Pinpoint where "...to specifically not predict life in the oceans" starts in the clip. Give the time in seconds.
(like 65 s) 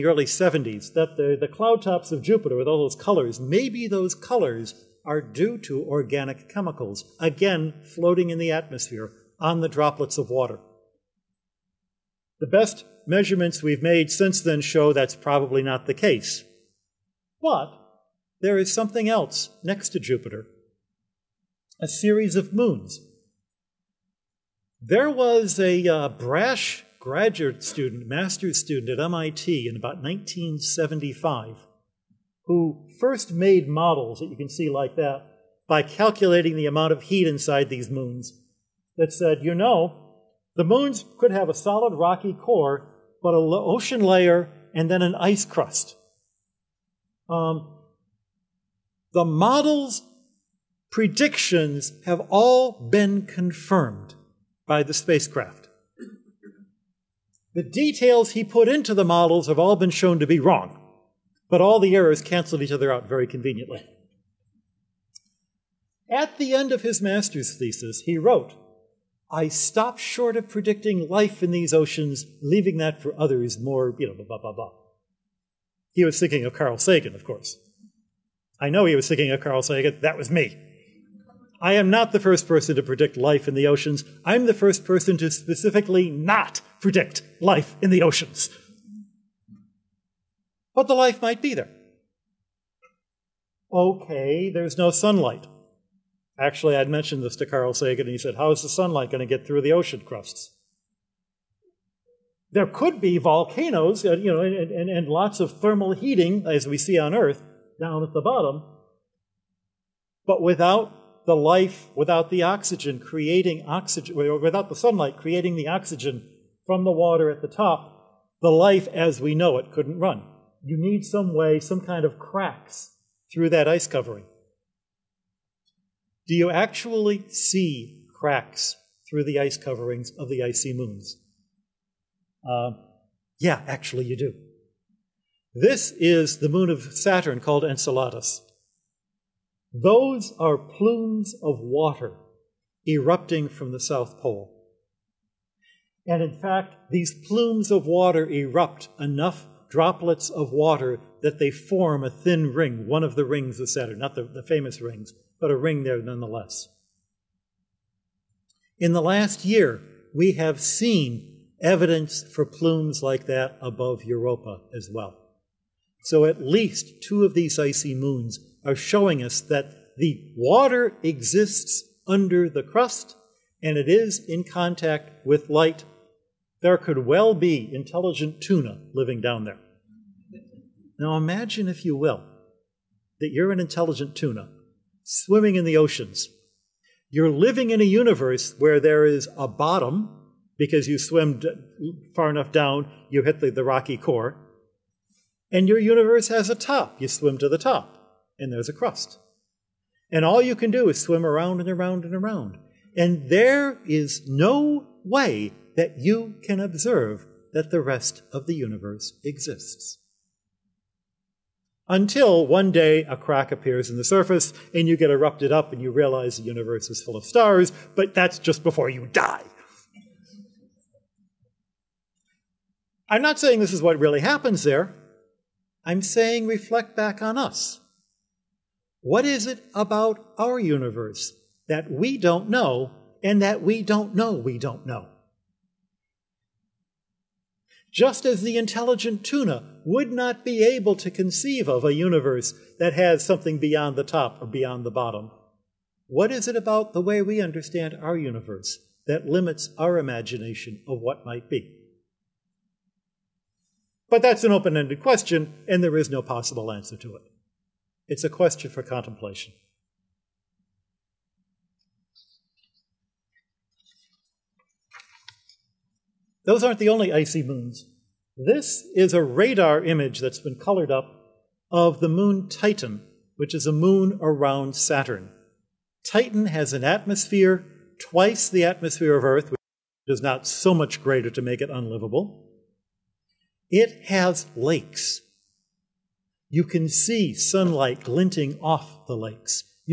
85 s.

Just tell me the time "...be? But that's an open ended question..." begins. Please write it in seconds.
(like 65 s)
251 s.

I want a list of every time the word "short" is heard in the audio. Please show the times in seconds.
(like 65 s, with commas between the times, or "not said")
69 s.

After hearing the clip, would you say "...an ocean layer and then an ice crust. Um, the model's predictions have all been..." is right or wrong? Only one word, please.
right.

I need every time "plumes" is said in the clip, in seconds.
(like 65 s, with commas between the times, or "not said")
140 s, 147 s, 162 s.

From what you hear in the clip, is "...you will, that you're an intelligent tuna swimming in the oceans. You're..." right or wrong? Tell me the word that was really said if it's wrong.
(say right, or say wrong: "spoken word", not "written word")
right.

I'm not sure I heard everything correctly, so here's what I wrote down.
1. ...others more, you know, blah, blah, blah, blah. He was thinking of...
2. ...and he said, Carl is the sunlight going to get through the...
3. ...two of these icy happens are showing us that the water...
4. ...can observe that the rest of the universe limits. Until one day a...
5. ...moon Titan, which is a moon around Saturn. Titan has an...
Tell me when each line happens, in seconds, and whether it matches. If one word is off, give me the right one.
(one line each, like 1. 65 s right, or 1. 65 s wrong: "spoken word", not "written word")
1. 73 s right
2. 98 s wrong: "How", not "Carl"
3. 167 s wrong: "moons", not "happens"
4. 206 s wrong: "exists", not "limits"
5. 272 s right.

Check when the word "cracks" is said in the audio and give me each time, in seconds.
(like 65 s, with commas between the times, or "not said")
122 s, 128 s, 213 s.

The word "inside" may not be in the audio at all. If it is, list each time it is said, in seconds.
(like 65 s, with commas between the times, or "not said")
37 s.